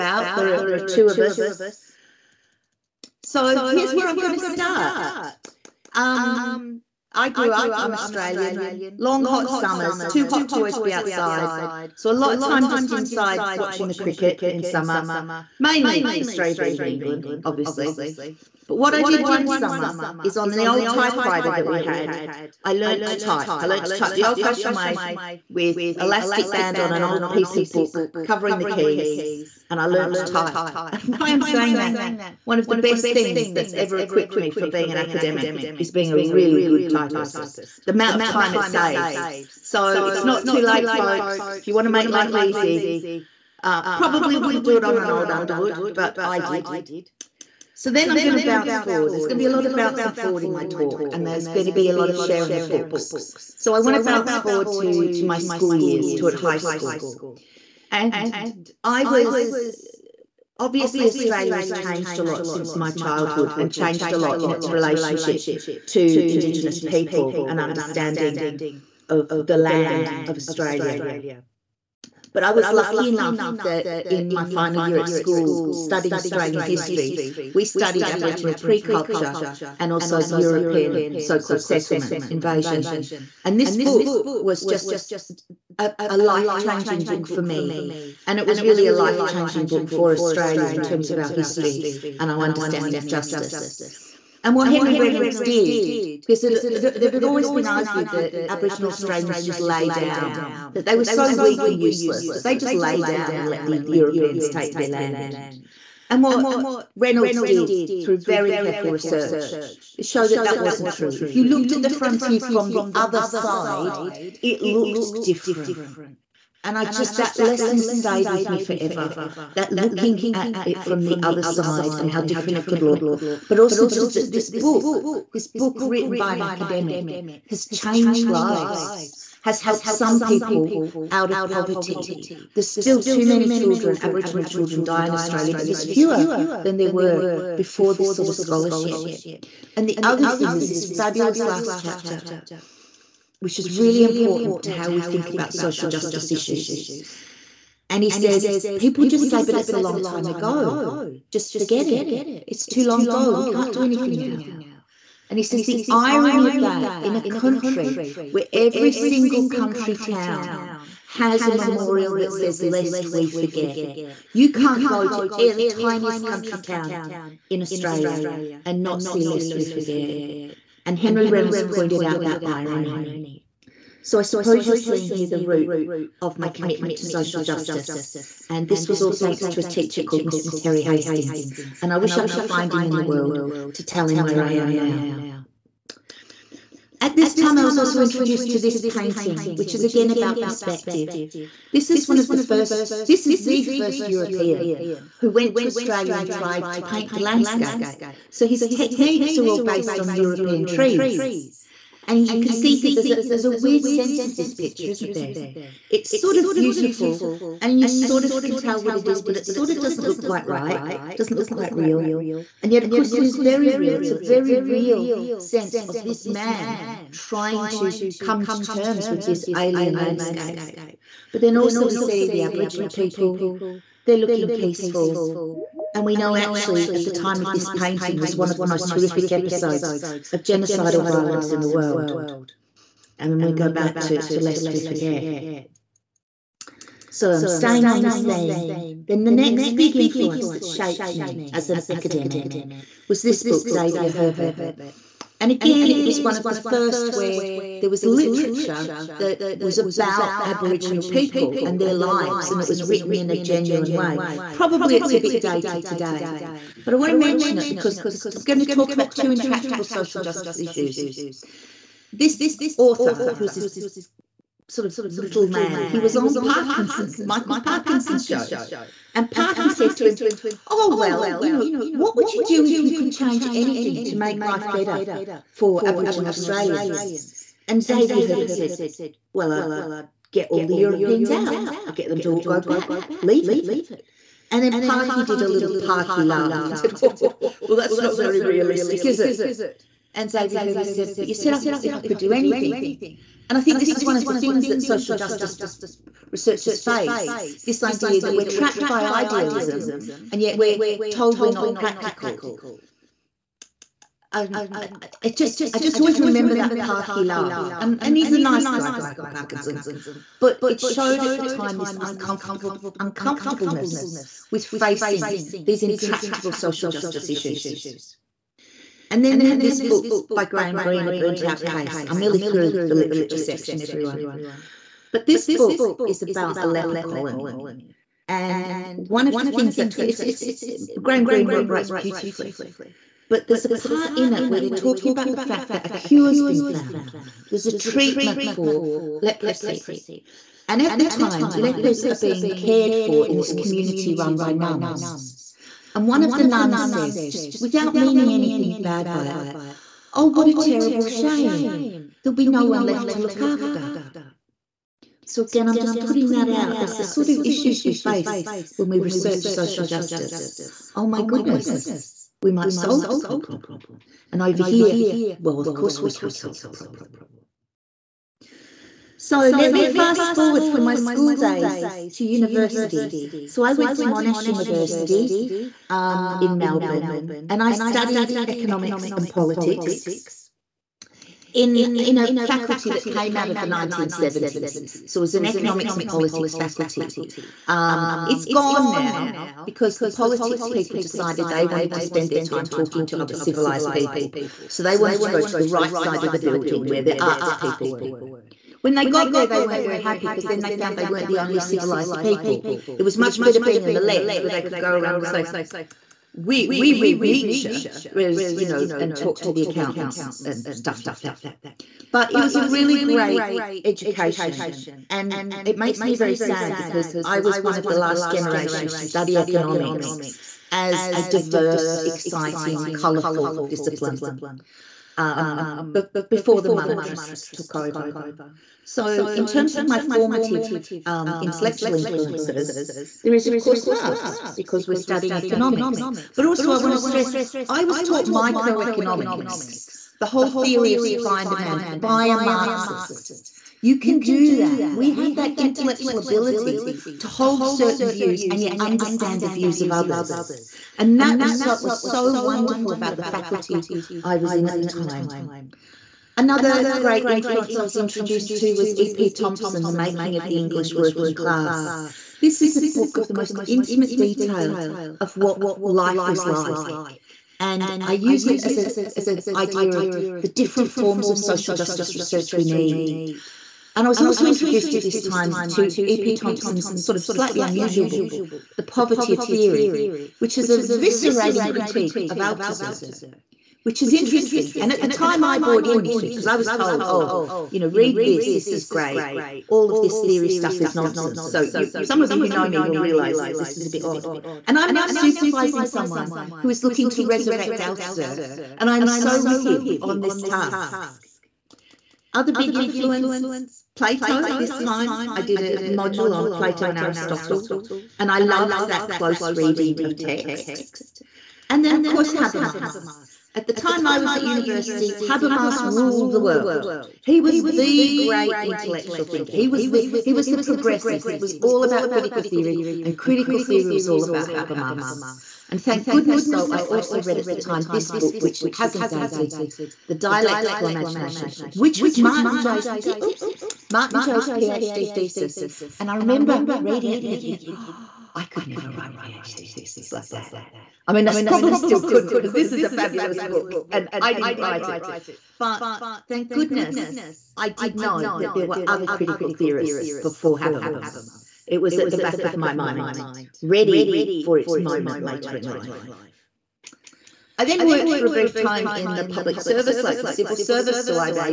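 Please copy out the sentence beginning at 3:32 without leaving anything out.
And yet, of course, it is very real.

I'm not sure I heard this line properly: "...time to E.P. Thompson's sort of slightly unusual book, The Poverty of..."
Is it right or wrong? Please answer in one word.
right.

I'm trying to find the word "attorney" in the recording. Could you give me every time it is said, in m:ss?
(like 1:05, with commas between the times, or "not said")
not said.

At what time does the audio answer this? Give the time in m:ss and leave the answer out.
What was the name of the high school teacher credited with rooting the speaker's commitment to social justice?
3:00.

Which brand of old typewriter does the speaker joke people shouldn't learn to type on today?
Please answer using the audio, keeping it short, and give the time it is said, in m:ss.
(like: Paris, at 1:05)
Underwood, at 0:45.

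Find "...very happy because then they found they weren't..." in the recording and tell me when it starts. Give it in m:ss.
6:39.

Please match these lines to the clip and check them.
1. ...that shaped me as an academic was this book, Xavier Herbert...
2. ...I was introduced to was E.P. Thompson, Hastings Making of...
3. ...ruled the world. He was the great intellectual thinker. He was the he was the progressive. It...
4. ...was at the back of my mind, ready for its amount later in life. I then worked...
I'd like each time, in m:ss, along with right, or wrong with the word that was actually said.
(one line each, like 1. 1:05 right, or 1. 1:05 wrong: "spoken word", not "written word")
1. 4:00 right
2. 7:37 wrong: "The", not "Hastings"
3. 8:35 right
4. 9:11 wrong: "moment", not "amount".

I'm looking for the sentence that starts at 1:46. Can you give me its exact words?
And what Reynolds did through very careful research is show that that wasn't true.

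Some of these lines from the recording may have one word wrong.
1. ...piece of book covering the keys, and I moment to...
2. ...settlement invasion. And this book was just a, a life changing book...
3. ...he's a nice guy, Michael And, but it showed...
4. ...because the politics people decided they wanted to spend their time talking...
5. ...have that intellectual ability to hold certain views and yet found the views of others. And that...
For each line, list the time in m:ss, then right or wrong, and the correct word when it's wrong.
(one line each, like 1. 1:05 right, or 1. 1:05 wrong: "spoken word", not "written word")
1. 0:27 wrong: "learnt", not "moment"
2. 1:21 right
3. 5:08 wrong: "Parkinson", not "And"
4. 6:29 right
5. 7:25 wrong: "understand", not "found".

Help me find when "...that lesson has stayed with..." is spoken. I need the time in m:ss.
1:57.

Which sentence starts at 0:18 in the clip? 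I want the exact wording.
But what I did one summer is on the old typewriter that we had, I learnt to type.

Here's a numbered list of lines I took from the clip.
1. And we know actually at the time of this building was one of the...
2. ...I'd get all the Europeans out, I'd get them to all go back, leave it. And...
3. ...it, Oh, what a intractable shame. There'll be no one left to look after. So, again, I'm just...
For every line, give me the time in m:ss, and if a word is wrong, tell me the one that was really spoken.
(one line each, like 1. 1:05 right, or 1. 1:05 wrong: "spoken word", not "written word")
1. 3:45 wrong: "painting", not "building"
2. 4:39 right
3. 5:49 wrong: "terrible", not "intractable".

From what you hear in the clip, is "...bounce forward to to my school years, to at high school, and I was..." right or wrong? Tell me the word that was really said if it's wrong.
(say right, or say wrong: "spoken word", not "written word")
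right.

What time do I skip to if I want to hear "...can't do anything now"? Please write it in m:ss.
2:33.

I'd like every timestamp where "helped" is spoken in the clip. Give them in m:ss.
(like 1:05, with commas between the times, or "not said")
2:09.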